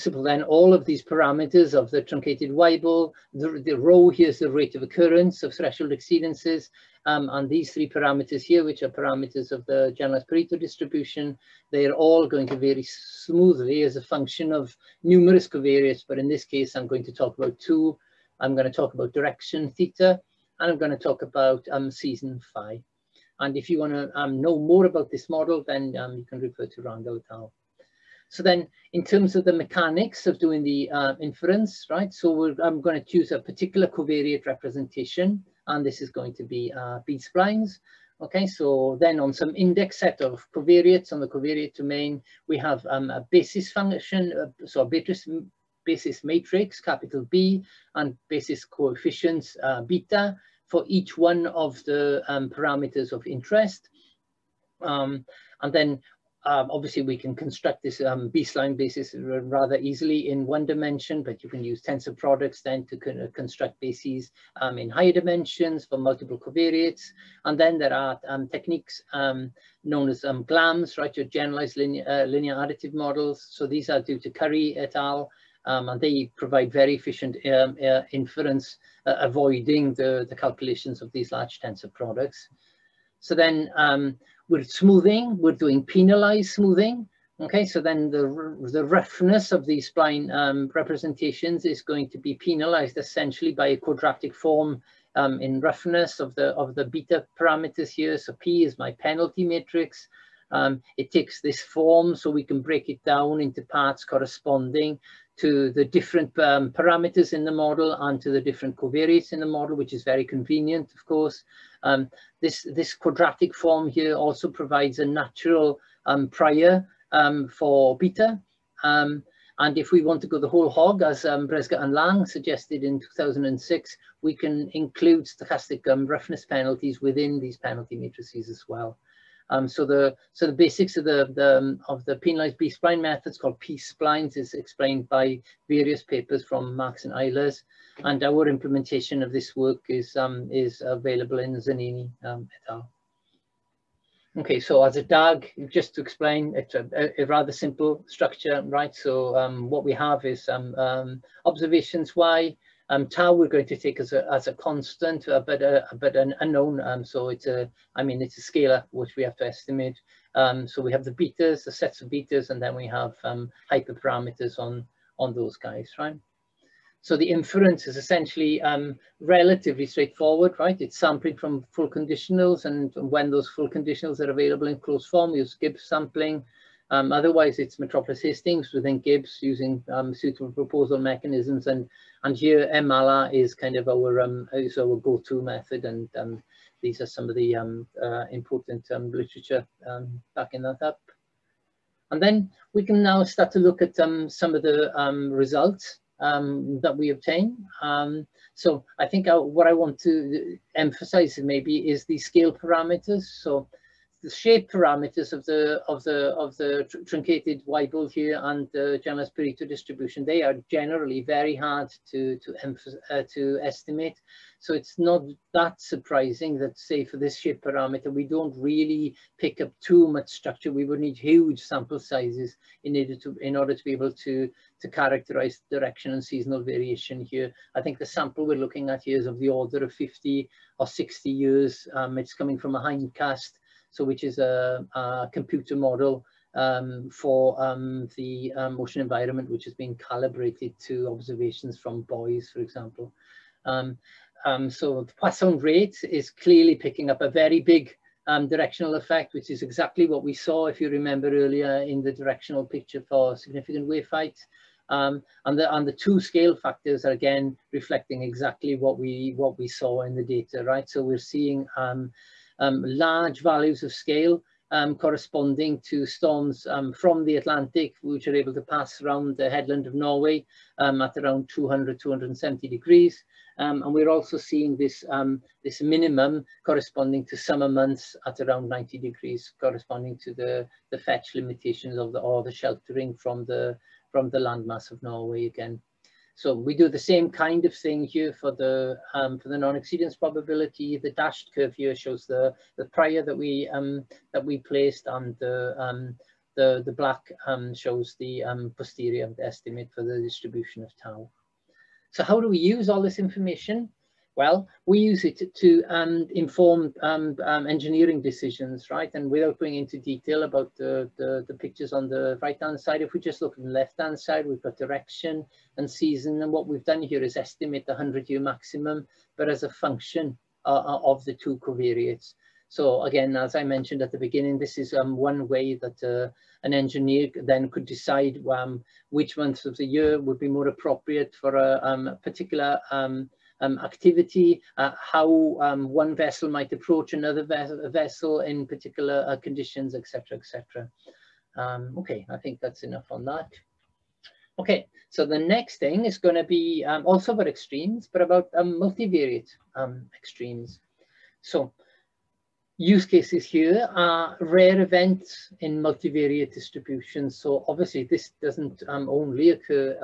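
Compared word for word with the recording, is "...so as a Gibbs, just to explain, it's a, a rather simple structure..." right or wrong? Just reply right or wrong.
wrong.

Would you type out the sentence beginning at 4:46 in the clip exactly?
So we do the same kind of thing here for the um, for the non-exceedance probability.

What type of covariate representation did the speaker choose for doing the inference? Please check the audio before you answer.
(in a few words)
B-splines.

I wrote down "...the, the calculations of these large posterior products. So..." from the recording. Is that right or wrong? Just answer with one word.
wrong.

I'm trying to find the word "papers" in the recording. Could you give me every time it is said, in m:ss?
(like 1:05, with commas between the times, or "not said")
2:16.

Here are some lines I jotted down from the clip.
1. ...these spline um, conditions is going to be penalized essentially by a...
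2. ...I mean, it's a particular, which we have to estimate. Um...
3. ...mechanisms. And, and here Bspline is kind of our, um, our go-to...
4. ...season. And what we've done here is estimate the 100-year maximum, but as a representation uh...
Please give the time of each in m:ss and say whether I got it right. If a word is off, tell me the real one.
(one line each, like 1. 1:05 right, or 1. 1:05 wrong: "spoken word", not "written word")
1. 1:29 wrong: "representations", not "conditions"
2. 2:37 wrong: "scalar", not "particular"
3. 3:00 wrong: "MALA", not "Bspline"
4. 5:15 wrong: "function", not "representation".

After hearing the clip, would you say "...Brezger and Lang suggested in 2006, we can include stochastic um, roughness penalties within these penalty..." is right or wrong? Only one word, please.
right.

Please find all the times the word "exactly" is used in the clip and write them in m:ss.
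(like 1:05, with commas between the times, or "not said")
4:09, 4:18.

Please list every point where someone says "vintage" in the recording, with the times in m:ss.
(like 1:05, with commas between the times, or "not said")
not said.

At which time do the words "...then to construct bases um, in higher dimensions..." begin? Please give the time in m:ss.
1:02.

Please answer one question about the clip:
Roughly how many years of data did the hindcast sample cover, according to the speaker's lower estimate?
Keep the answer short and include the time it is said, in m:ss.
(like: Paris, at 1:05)
50, at 3:49.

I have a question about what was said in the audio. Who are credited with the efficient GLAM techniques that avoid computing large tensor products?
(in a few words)
Currie et al.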